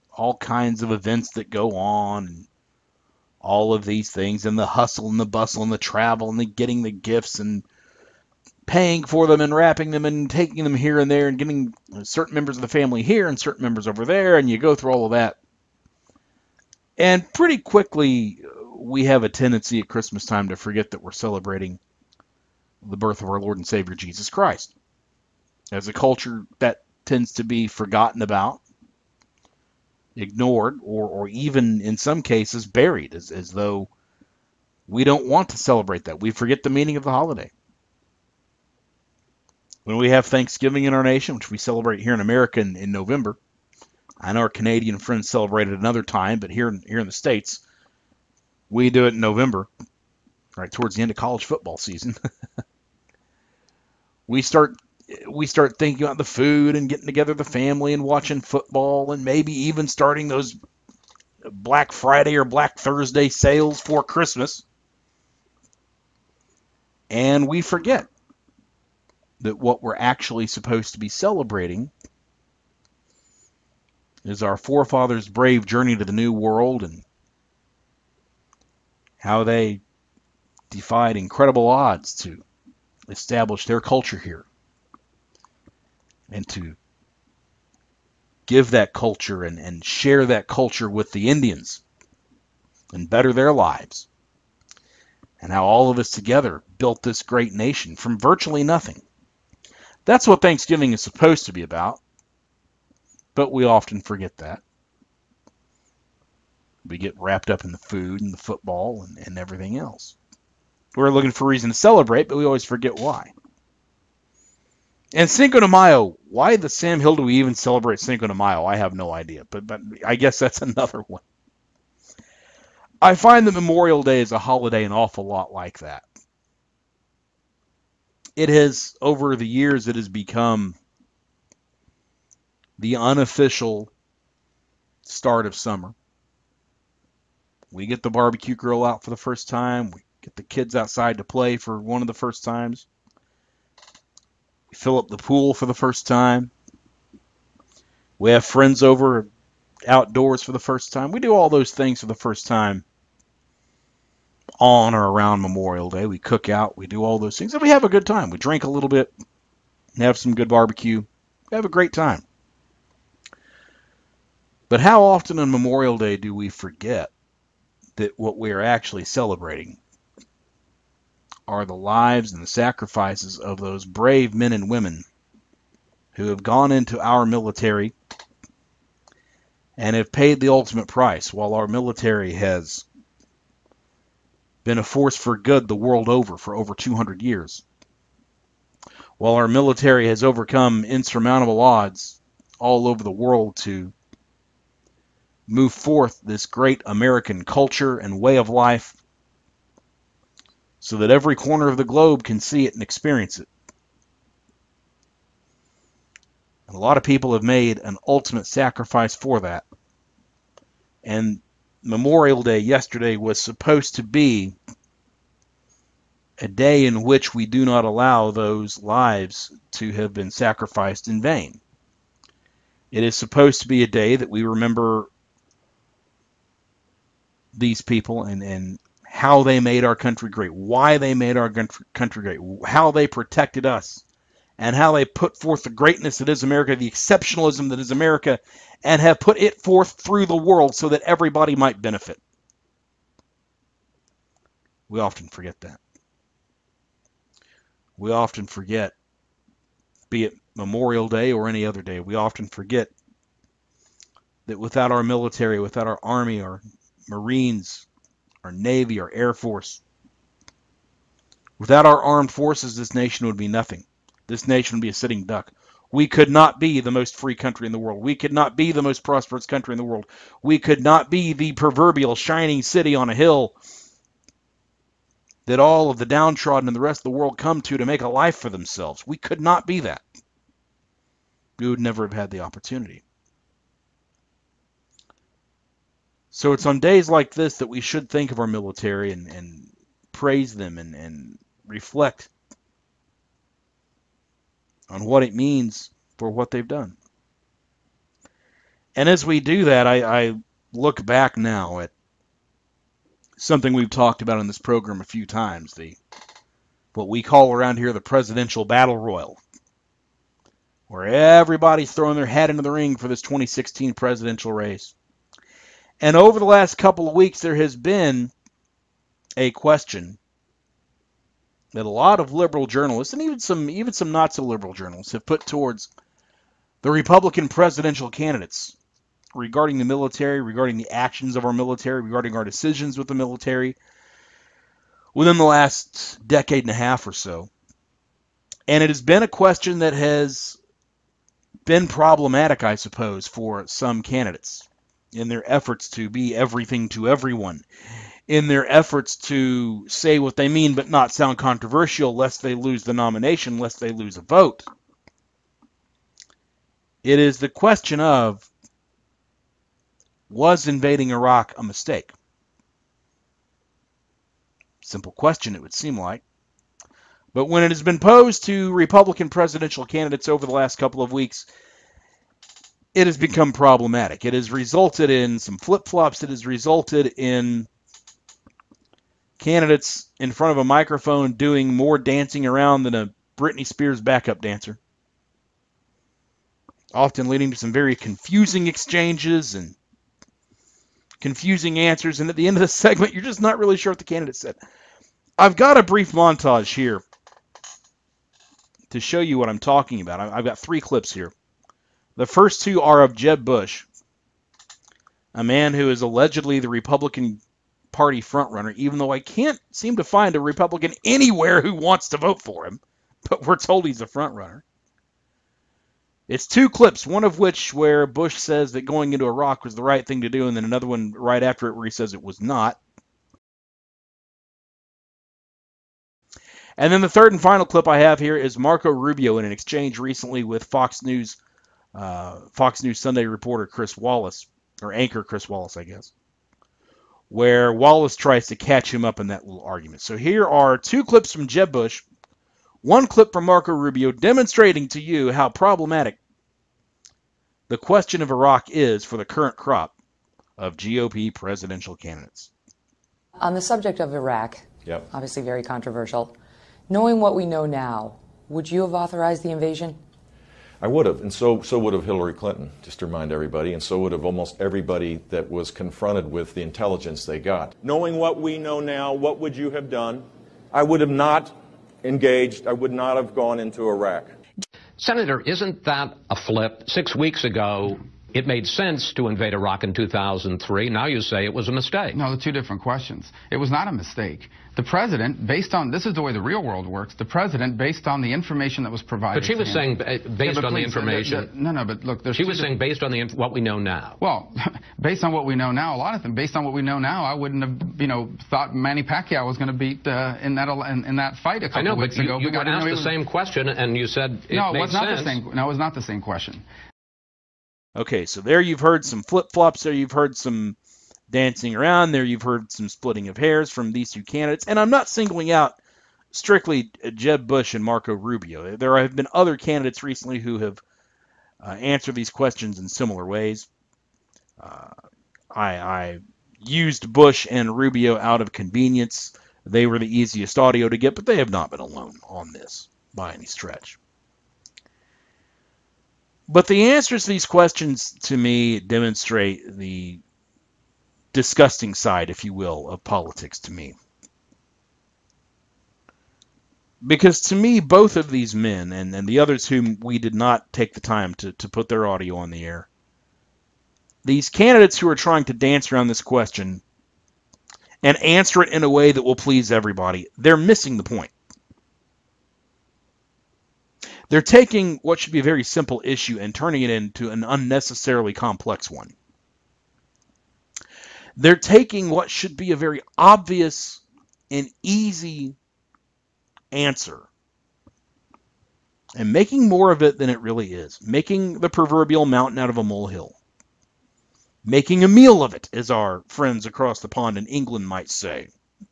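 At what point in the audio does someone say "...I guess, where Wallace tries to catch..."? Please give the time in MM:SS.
07:15.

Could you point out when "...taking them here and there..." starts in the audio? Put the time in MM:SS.
00:10.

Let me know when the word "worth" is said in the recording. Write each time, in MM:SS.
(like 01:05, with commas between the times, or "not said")
not said.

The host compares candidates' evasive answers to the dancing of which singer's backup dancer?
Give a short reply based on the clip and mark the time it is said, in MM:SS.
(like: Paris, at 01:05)
Britney Spears, at 06:23.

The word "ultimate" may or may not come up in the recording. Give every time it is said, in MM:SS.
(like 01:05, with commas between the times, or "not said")
03:00, 03:28.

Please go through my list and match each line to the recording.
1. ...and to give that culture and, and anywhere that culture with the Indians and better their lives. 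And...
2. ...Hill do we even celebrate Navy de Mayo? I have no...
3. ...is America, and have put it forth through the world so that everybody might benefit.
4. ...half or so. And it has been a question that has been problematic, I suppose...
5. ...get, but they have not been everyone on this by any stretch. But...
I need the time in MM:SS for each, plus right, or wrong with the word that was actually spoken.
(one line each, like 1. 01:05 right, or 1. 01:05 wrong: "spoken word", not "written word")
1. 01:26 wrong: "share", not "anywhere"
2. 01:56 wrong: "Cinco", not "Navy"
3. 03:57 right
4. 05:36 right
5. 08:50 wrong: "alone", not "everyone".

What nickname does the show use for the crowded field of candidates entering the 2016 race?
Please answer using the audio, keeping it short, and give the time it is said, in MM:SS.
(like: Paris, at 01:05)
presidential battle royal, at 05:07.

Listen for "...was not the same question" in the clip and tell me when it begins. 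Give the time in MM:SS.
08:25.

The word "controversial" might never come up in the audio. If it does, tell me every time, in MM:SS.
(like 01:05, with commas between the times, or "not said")
05:51, 07:35.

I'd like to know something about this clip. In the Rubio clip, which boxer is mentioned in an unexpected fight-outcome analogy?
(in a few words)
Manny Pacquiao.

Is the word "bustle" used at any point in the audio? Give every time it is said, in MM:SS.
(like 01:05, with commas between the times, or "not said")
00:05.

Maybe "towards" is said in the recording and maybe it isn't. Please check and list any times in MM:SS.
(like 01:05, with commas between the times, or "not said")
00:50, 05:25.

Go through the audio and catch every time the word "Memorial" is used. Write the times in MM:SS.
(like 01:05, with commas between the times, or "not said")
02:03, 02:35, 02:45, 03:31, 04:10.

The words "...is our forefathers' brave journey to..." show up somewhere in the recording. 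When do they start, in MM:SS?
01:14.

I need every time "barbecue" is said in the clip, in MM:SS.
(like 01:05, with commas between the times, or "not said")
02:18, 02:40.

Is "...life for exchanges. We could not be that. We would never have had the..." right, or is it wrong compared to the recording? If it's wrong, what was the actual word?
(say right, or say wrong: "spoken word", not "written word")
wrong: "themselves", not "exchanges".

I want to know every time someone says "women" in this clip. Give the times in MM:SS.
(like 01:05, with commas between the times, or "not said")
02:54.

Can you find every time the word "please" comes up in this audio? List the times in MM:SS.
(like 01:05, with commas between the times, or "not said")
08:10, 09:19.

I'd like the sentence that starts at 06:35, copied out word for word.
I've got a brief montage here to show you what I'm talking about.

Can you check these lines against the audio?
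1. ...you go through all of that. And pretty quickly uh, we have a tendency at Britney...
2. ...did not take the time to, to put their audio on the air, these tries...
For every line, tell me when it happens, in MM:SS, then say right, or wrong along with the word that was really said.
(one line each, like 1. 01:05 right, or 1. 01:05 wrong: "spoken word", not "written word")
1. 00:14 wrong: "Christmas", not "Britney"
2. 09:10 wrong: "candidates", not "tries".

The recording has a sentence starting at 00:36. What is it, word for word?
We forget the meaning of the holiday.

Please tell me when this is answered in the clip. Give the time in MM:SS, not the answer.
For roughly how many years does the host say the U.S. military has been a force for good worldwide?
03:06.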